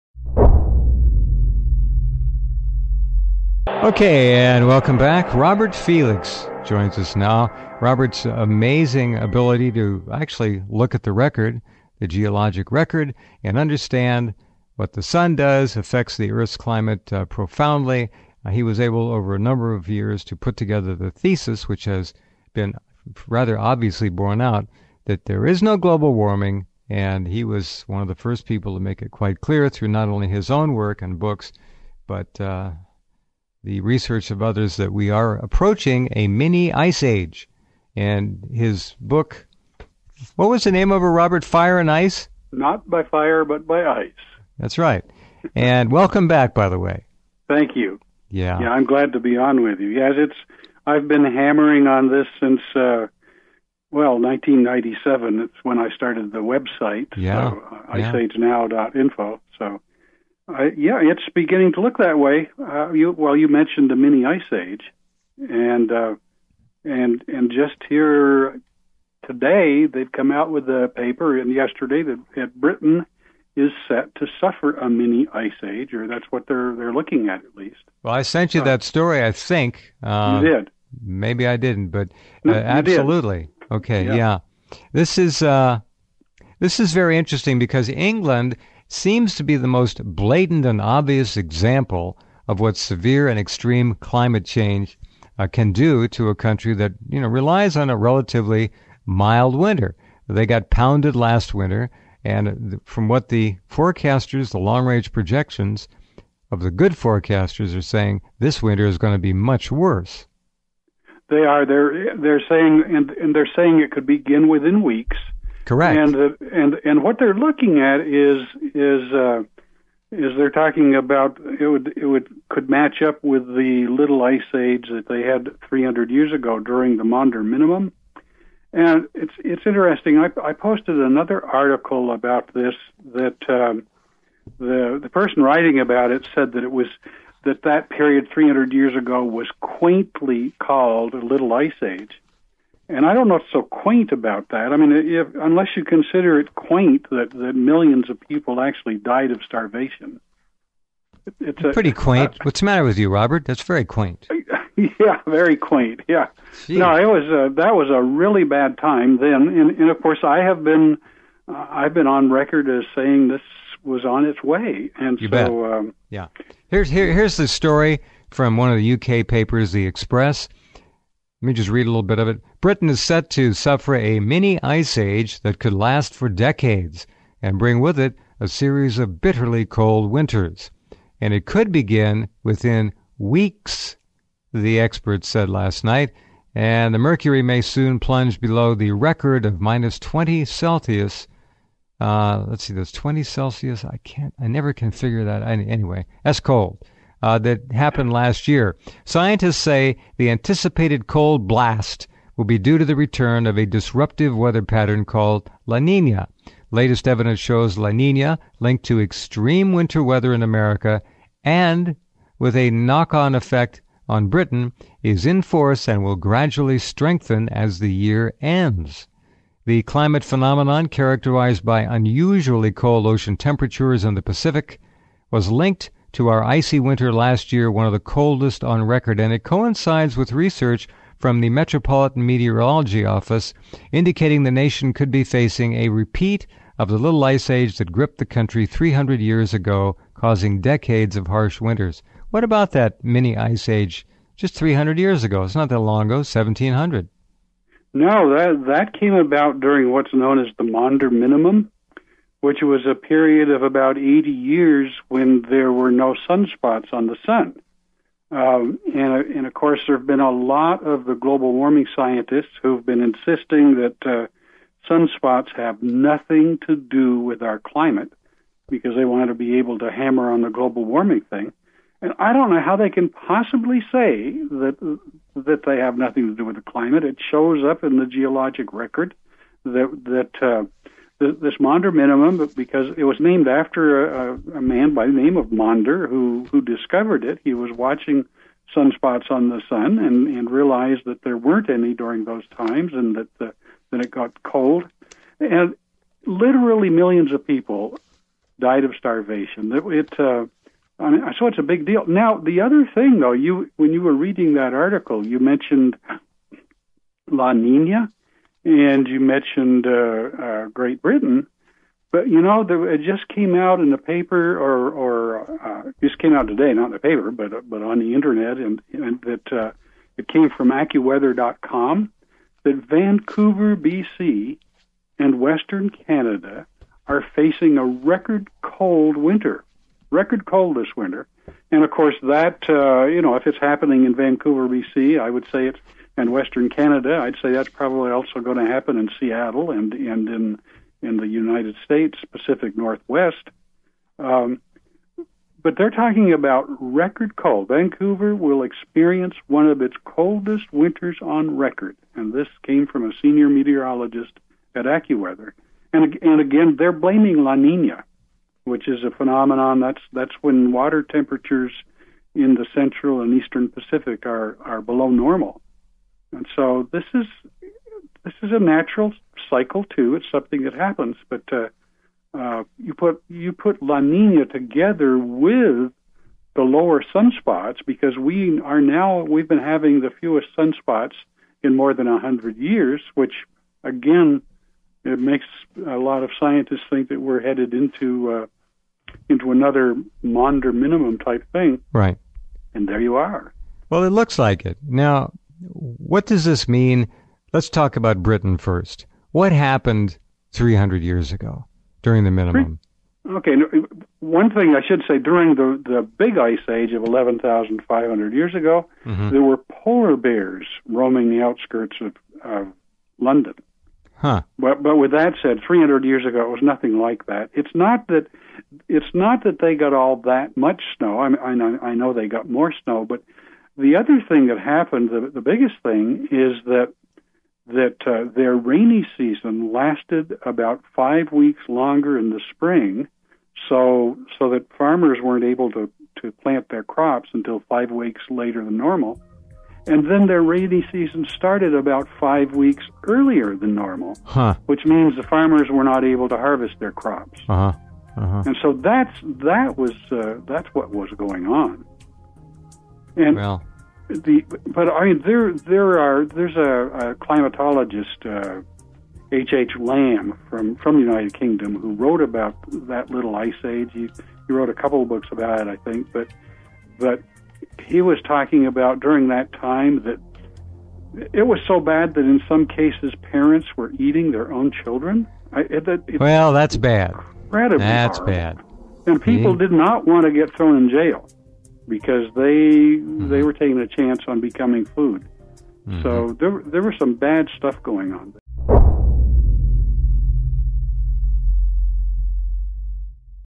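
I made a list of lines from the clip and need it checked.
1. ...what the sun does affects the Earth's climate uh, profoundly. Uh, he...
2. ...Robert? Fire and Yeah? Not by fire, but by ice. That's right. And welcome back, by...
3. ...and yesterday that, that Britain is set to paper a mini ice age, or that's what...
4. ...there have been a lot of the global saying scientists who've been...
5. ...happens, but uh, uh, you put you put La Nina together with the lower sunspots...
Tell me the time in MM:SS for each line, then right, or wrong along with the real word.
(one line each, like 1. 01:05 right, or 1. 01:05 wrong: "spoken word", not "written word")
1. 00:14 right
2. 00:41 wrong: "Ice", not "Yeah"
3. 01:11 wrong: "suffer", not "paper"
4. 04:19 wrong: "warming", not "saying"
5. 06:10 right.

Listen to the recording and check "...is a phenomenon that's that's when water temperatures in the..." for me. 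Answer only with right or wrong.
right.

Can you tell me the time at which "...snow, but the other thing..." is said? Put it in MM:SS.
07:02.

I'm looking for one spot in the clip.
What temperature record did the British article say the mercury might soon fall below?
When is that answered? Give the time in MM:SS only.
03:09.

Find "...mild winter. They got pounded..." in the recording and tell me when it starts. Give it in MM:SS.
01:39.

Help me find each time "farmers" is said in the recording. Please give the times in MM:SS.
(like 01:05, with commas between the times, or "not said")
07:14, 07:25.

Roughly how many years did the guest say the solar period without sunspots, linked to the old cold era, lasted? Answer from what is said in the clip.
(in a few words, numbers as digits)
80 years.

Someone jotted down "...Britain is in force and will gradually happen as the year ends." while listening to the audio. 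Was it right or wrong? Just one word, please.
wrong.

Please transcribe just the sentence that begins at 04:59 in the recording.
It, it uh, I mean, so it's a big deal.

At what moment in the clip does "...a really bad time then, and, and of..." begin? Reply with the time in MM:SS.
02:37.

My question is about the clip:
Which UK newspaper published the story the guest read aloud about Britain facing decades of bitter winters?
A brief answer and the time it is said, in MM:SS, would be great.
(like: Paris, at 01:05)
The Express, at 02:49.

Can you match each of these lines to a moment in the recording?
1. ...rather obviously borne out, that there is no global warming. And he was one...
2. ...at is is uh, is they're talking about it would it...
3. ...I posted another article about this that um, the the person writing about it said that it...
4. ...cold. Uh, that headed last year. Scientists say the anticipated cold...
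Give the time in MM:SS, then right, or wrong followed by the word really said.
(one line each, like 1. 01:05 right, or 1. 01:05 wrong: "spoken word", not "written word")
1. 00:23 right
2. 01:57 right
3. 02:10 right
4. 03:16 wrong: "happened", not "headed".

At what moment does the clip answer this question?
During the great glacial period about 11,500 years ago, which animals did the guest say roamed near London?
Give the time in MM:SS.
06:49.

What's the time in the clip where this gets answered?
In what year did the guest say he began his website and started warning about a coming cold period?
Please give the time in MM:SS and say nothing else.
00:54.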